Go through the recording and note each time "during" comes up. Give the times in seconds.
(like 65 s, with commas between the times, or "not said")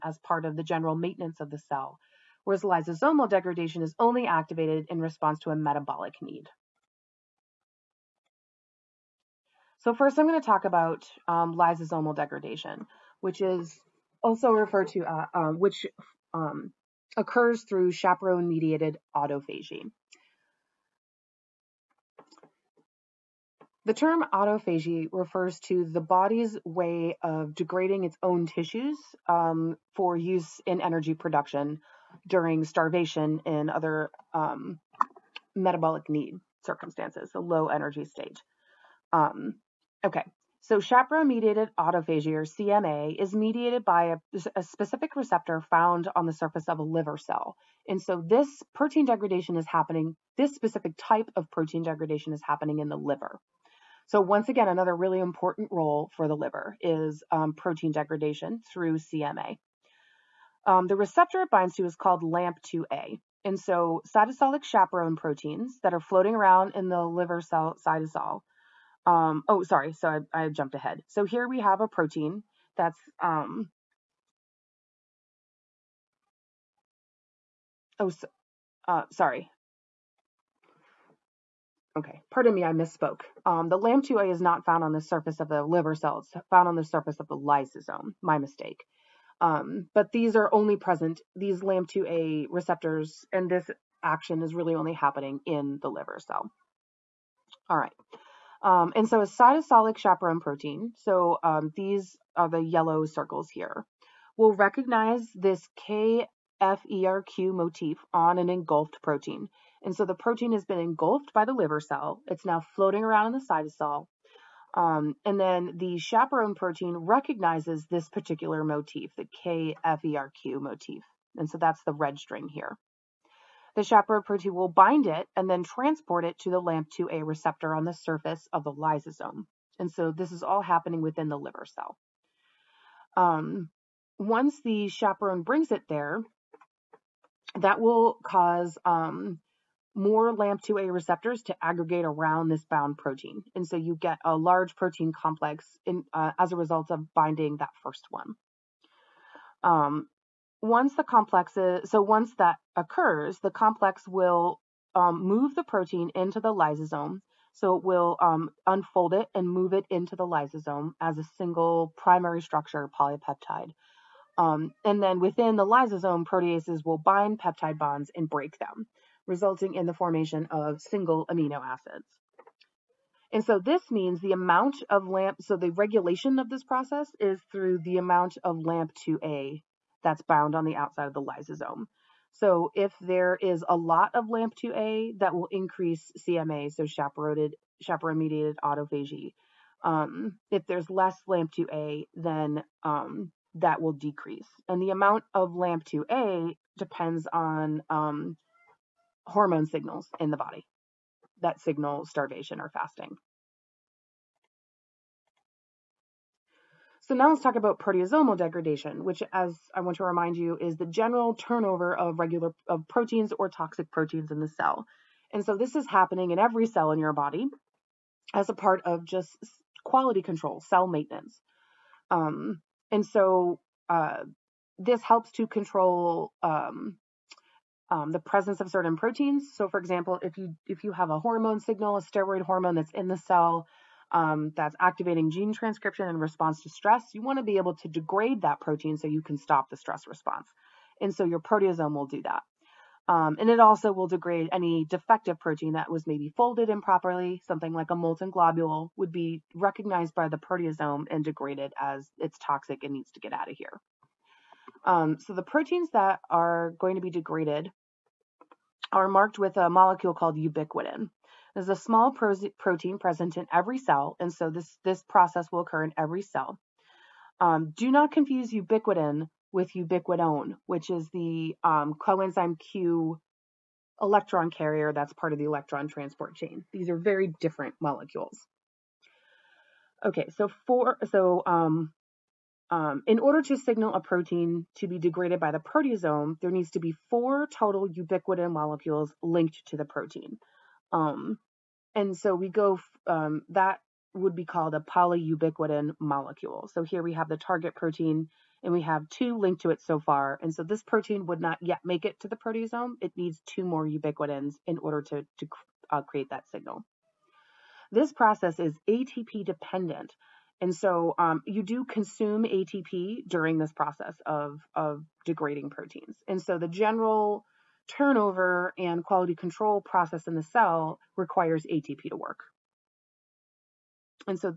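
32 s, 313 s.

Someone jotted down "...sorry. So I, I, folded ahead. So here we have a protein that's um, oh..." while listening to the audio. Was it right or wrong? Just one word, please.
wrong.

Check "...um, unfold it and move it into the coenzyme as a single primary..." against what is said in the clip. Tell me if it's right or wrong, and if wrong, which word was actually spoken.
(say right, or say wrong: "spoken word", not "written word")
wrong: "lysosome", not "coenzyme".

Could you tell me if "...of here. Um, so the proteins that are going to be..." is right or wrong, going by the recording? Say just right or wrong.
right.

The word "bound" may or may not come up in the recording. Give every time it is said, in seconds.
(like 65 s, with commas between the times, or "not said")
142 s, 180 s.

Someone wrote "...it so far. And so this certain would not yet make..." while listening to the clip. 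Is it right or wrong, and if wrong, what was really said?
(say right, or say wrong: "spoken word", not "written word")
wrong: "protein", not "certain".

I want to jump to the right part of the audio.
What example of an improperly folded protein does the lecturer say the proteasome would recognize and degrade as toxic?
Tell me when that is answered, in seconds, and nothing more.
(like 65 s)
247 s.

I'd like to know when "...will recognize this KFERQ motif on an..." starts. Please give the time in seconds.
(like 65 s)
104 s.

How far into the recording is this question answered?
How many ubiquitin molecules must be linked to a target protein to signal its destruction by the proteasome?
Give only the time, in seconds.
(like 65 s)
287 s.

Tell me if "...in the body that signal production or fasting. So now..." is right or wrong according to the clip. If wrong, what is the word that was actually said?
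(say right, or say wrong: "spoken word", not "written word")
wrong: "starvation", not "production".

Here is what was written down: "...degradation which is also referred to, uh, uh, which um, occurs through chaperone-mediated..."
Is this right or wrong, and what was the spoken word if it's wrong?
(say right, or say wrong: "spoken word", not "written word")
right.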